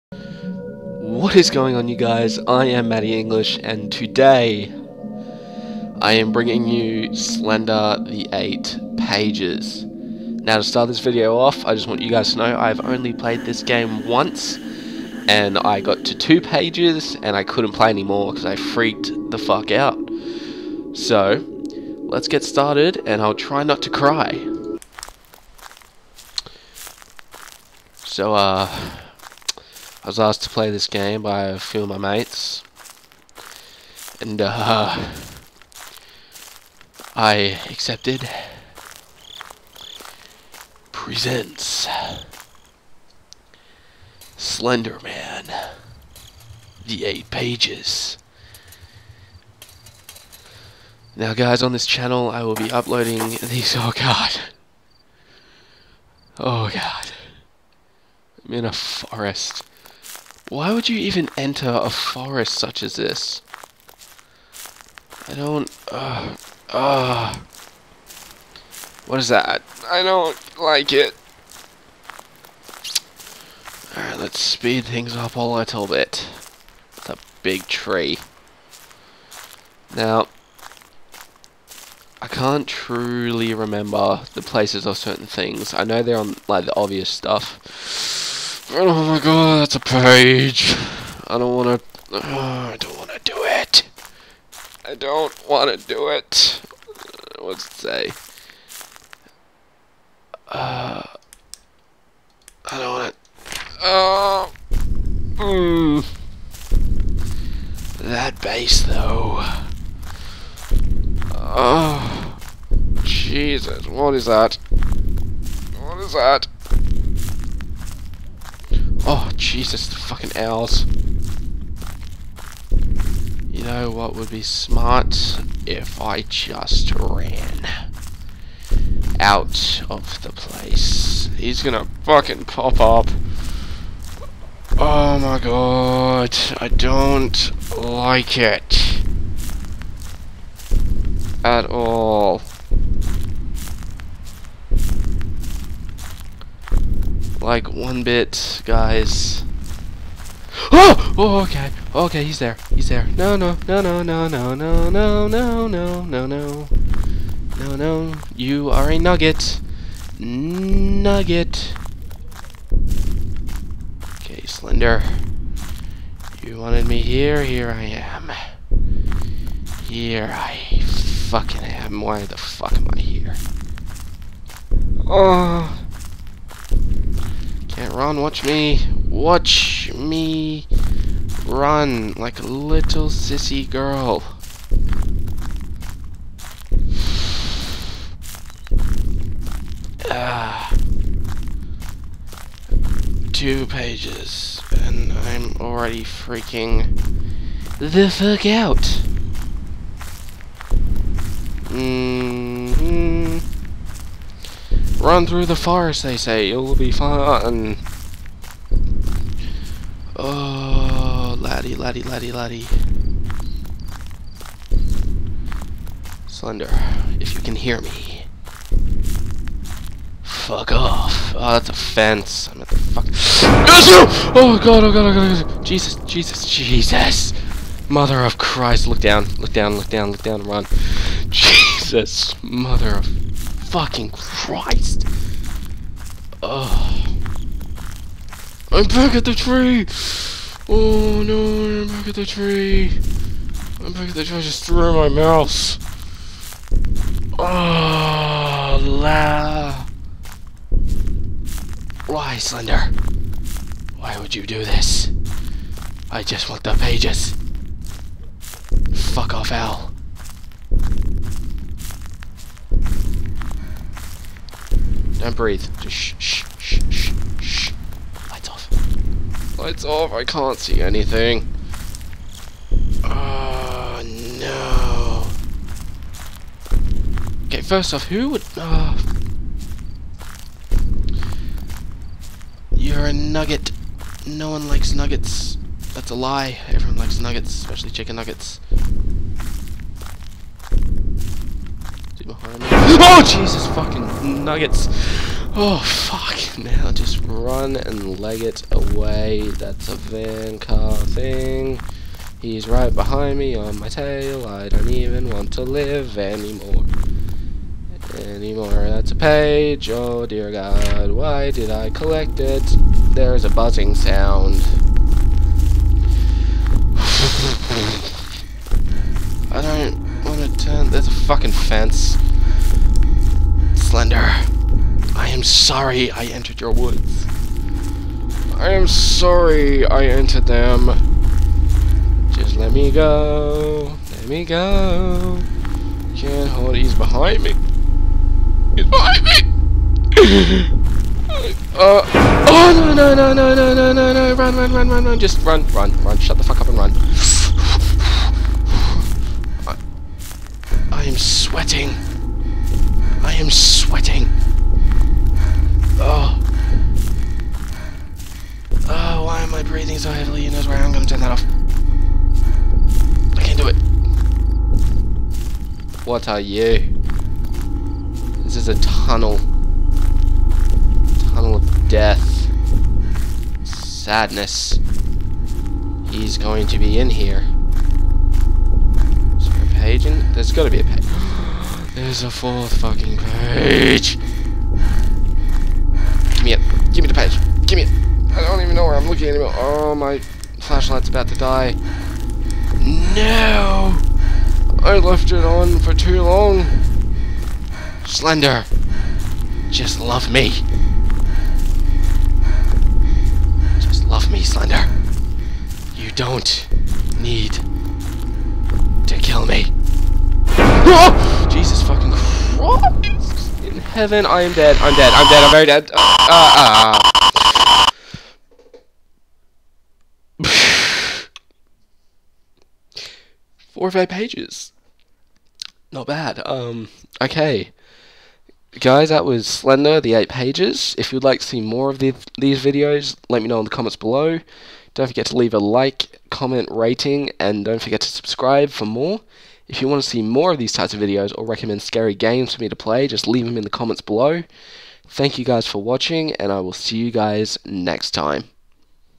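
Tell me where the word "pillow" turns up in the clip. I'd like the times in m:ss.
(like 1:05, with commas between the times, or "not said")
not said.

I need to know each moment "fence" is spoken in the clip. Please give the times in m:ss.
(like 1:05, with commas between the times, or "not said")
3:41, 5:21.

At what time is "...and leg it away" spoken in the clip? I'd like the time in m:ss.
4:57.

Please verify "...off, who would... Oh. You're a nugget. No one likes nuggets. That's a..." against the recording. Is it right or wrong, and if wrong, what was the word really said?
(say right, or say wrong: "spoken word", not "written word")
right.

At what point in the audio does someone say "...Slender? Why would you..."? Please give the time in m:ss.
4:12.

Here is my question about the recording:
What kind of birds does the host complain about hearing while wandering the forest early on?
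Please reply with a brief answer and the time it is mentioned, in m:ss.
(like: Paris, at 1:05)
Owls, at 1:59.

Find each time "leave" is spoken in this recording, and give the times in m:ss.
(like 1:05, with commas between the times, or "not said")
7:15, 7:23.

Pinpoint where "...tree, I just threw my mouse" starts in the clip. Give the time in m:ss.
4:04.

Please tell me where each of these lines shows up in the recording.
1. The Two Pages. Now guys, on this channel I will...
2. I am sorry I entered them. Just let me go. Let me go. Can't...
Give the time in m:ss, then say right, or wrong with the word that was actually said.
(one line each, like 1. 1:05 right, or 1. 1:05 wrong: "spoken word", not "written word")
1. 0:46 wrong: "Eight", not "Two"
2. 5:28 right.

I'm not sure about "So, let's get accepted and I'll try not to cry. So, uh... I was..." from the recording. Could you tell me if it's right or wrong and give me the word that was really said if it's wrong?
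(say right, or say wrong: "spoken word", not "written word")
wrong: "started", not "accepted".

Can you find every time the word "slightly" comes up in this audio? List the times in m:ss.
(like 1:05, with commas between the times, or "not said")
not said.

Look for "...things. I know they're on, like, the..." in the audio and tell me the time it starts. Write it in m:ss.
1:25.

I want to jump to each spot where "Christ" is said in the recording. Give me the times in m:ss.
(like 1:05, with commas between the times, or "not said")
3:48, 3:54.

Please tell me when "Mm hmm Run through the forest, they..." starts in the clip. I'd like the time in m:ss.
3:21.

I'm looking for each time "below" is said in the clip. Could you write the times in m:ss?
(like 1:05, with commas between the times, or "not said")
7:13, 7:24.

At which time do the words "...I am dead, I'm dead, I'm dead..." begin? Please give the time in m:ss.
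6:54.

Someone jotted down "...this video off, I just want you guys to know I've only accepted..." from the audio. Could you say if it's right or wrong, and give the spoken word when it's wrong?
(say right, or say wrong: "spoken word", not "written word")
wrong: "played", not "accepted".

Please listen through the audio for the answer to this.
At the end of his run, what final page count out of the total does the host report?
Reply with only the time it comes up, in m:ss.
7:03.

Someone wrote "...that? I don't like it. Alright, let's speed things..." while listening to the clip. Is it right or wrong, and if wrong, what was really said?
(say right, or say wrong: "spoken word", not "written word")
right.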